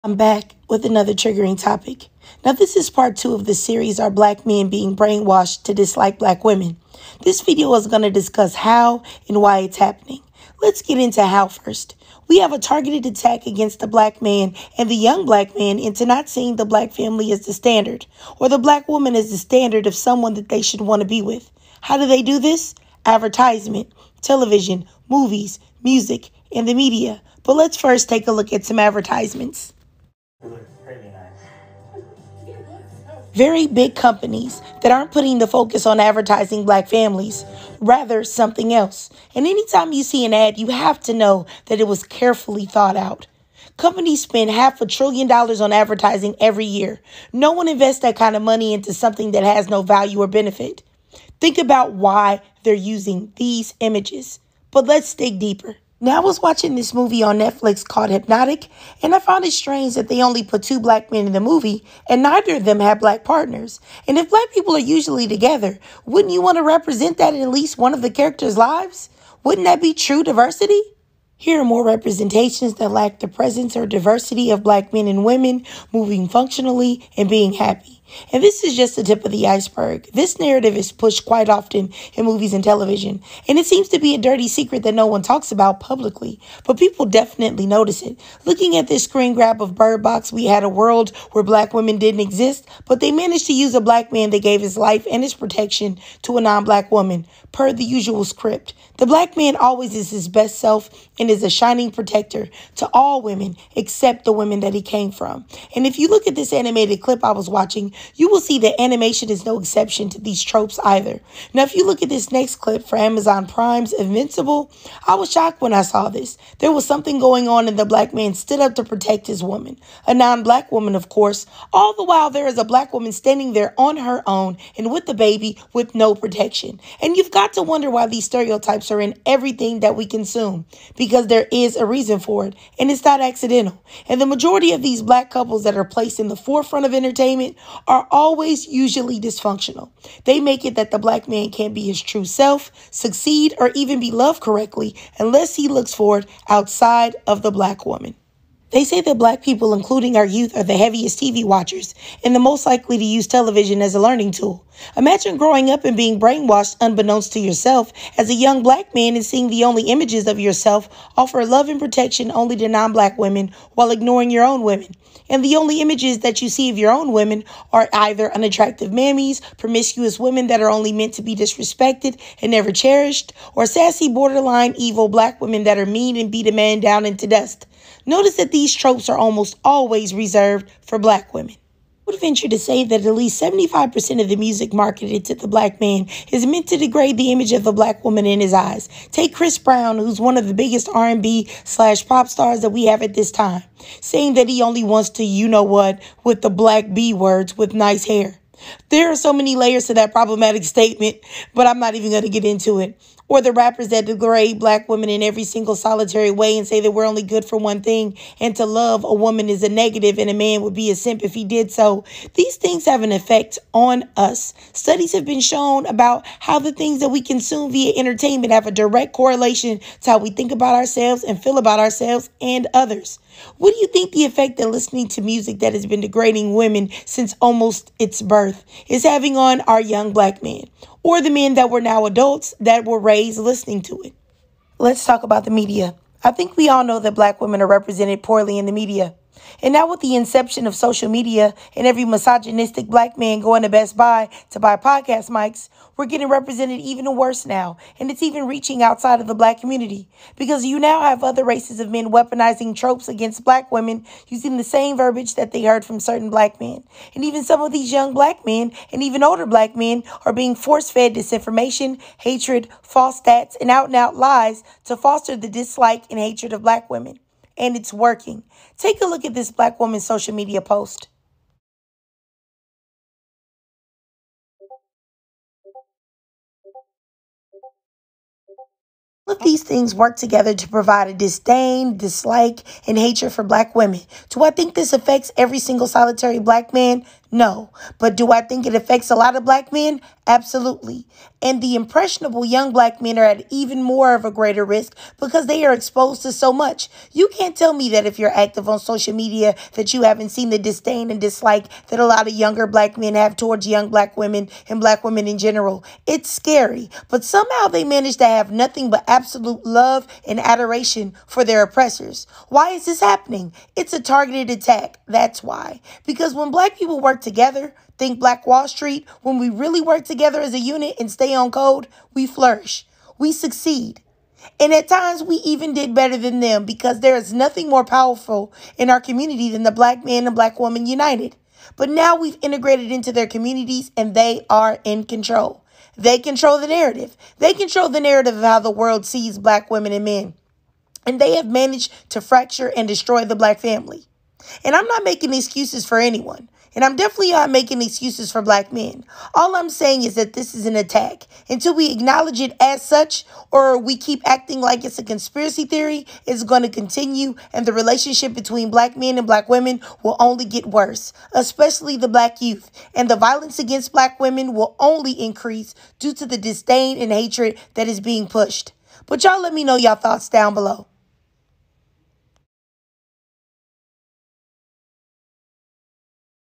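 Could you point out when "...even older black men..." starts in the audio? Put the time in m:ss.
4:19.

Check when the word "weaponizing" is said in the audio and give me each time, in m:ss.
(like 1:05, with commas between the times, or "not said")
4:12.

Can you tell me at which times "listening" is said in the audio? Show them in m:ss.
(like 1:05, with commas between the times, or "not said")
3:44, 3:53.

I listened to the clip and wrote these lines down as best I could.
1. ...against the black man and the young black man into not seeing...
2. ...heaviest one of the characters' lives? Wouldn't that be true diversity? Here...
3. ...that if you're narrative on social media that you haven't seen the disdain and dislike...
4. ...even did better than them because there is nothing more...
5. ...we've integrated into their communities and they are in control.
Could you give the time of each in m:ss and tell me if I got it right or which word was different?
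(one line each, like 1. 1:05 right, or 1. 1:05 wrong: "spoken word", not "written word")
1. 0:13 right
2. 1:07 wrong: "least", not "heaviest"
3. 4:57 wrong: "active", not "narrative"
4. 5:25 right
5. 5:32 right.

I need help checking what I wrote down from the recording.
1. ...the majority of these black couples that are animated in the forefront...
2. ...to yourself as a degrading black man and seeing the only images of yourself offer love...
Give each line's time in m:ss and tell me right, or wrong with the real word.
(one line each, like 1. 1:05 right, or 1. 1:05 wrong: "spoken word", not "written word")
1. 2:14 wrong: "placed", not "animated"
2. 2:37 wrong: "young", not "degrading".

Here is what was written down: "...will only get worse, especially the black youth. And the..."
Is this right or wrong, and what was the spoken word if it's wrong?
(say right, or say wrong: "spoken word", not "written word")
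right.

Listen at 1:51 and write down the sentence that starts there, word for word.
Now, if you look at this next clip for Amazon Prime's Invincible, I was shocked when I saw this.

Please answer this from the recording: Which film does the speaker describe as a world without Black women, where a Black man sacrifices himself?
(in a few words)
Bird Box.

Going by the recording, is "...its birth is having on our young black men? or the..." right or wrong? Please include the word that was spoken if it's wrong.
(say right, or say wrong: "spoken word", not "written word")
right.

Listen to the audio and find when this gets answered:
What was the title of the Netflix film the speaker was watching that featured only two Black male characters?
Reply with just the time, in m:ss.
0:58.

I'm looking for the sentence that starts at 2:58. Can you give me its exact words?
Notice that these tropes are almost always reserved for black women.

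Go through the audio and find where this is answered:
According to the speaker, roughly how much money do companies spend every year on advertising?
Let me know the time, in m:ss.
0:44.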